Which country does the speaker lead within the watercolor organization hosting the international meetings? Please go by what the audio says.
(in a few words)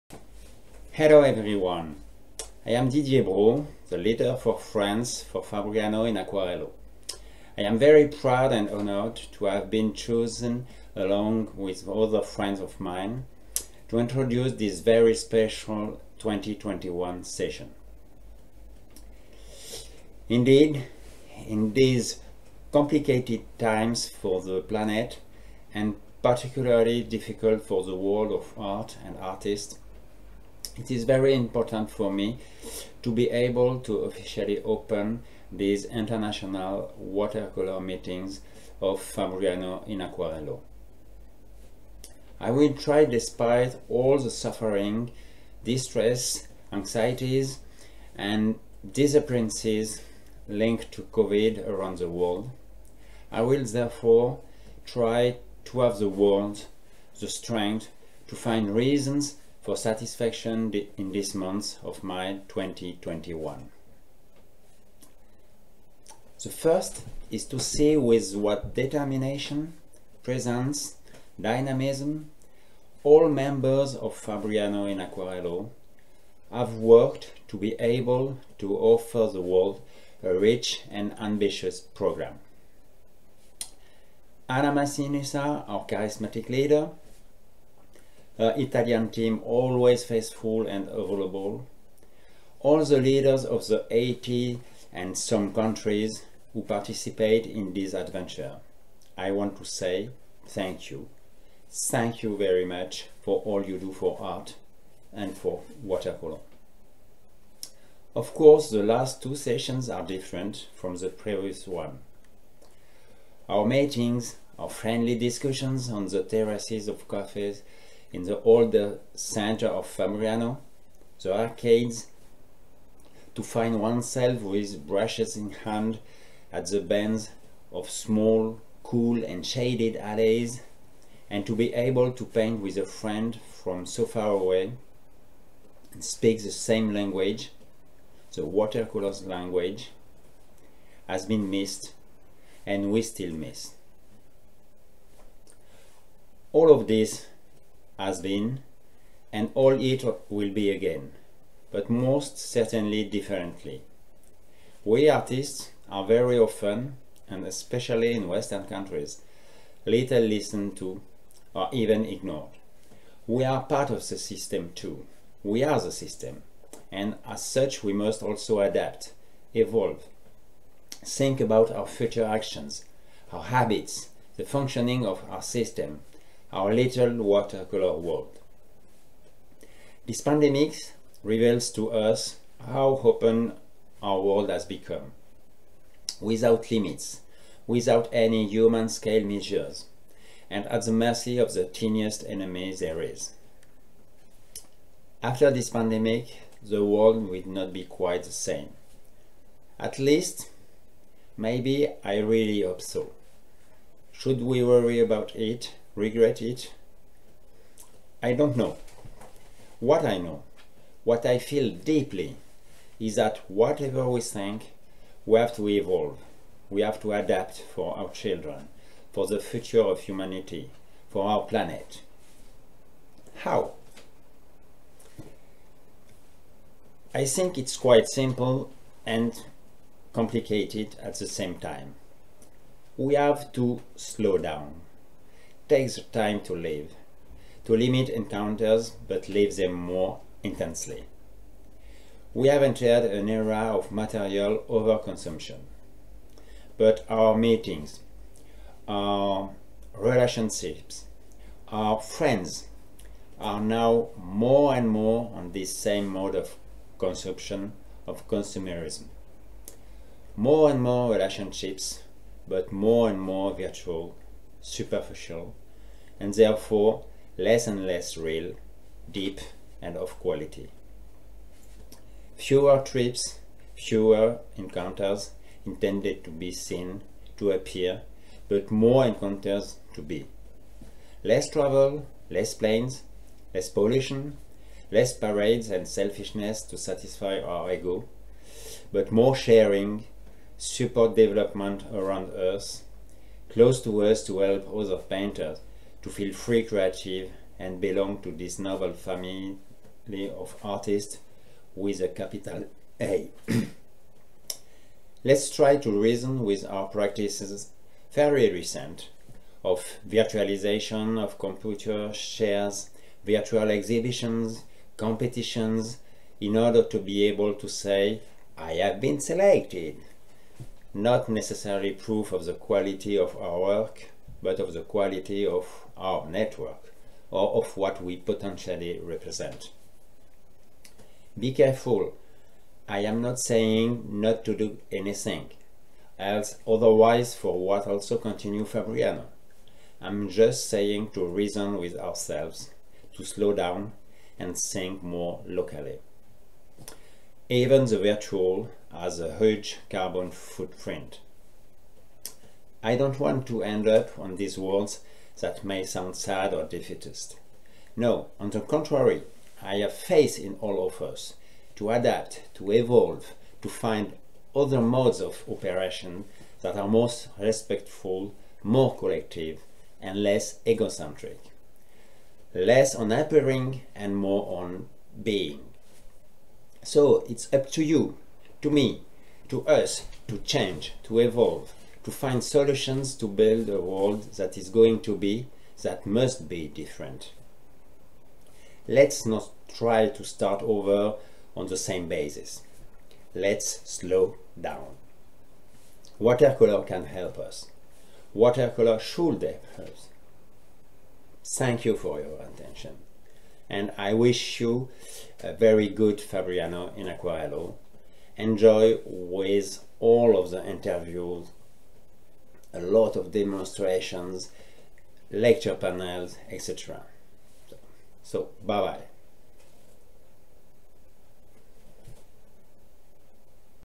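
France.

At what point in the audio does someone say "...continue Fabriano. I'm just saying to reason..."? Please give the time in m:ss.
5:38.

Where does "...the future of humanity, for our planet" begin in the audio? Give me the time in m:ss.
3:39.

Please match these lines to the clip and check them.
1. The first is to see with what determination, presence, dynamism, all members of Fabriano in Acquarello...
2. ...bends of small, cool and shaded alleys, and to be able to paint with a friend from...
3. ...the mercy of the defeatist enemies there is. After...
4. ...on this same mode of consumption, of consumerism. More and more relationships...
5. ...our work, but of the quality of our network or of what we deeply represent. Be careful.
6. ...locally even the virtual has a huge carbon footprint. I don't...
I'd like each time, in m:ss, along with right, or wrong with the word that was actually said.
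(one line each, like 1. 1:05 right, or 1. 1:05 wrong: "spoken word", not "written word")
1. 1:06 right
2. 2:06 right
3. 3:10 wrong: "tiniest", not "defeatist"
4. 4:15 right
5. 5:23 wrong: "potentially", not "deeply"
6. 5:45 right.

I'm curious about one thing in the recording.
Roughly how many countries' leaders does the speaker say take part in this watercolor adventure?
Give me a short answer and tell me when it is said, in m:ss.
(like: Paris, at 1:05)
80 and some, at 1:33.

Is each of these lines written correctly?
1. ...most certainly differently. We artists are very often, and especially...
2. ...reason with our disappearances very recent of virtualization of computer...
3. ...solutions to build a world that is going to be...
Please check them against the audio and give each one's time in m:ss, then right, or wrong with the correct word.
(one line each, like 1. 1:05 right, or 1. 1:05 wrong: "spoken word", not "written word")
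1. 2:31 right
2. 5:06 wrong: "practices", not "disappearances"
3. 6:22 right.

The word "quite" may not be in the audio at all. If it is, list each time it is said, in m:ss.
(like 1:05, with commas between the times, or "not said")
3:17, 3:47.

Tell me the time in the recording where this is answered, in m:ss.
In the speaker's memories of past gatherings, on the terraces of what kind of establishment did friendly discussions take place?
1:57.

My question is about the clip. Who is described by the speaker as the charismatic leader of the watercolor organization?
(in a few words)
Anna Massinissa.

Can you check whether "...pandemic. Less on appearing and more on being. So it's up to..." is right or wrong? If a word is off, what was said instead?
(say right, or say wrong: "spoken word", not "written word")
wrong: "egocentric", not "pandemic".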